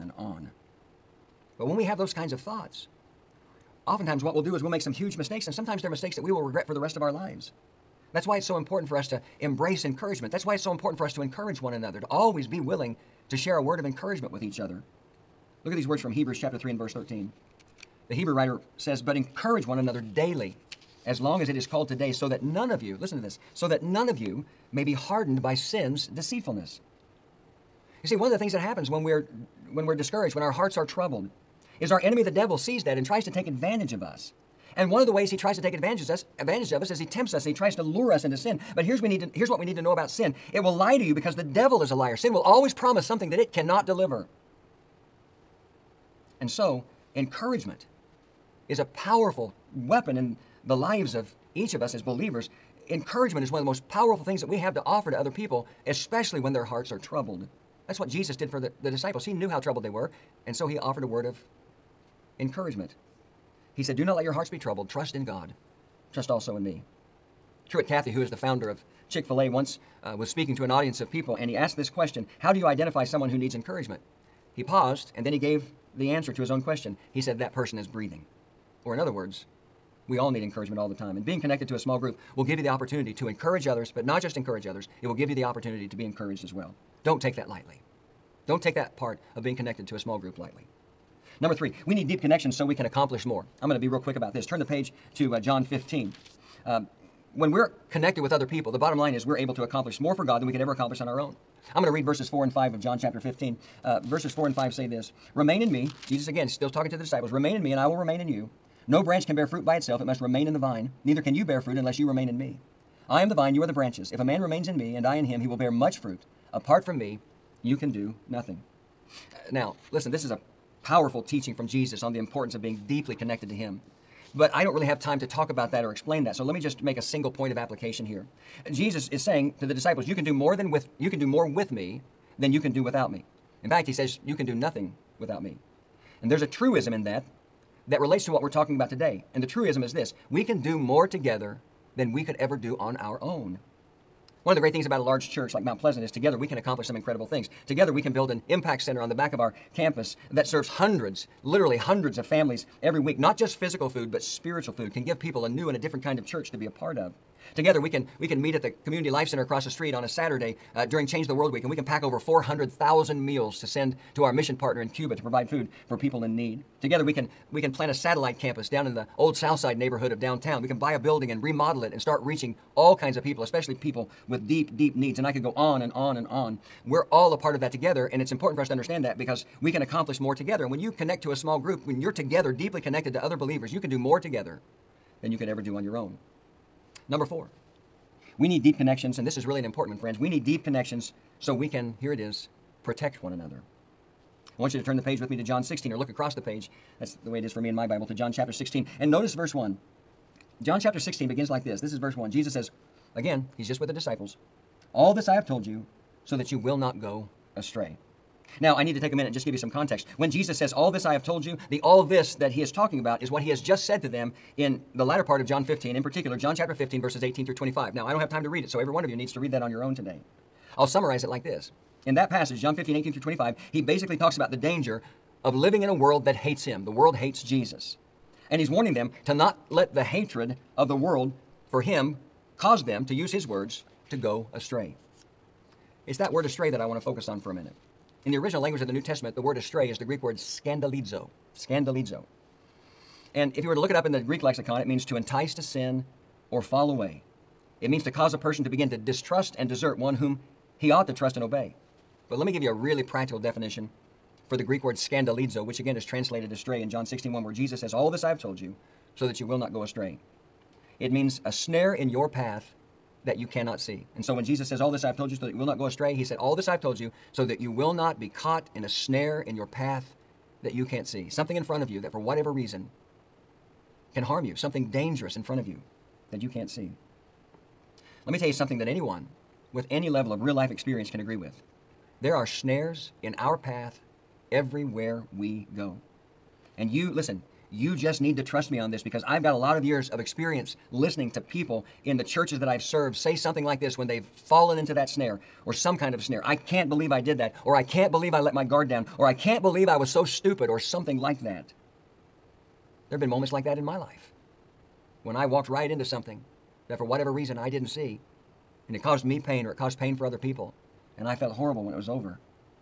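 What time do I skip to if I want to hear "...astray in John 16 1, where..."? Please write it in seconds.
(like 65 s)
256 s.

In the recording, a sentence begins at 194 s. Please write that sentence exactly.
I want you to turn the page with me to John 16 or look across the page.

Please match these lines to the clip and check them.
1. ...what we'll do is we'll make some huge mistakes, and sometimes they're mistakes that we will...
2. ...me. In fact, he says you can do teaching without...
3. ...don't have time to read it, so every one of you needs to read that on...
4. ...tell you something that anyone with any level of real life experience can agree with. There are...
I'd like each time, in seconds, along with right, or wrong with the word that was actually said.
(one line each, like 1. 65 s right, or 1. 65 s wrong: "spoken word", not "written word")
1. 4 s right
2. 133 s wrong: "nothing", not "teaching"
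3. 218 s right
4. 278 s right.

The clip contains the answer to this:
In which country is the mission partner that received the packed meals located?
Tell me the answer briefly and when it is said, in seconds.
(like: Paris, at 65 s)
Cuba, at 164 s.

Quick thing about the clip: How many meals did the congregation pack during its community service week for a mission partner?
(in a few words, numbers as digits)
400,000.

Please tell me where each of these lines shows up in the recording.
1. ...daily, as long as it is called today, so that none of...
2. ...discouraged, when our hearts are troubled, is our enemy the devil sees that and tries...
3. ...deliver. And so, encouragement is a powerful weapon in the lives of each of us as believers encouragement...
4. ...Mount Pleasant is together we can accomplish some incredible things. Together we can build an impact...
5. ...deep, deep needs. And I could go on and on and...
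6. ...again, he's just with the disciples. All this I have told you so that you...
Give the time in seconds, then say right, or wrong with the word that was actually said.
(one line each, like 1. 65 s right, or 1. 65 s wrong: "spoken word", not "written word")
1. 20 s right
2. 29 s right
3. 43 s right
4. 145 s right
5. 174 s right
6. 203 s right.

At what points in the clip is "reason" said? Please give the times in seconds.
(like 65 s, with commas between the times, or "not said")
272 s, 307 s.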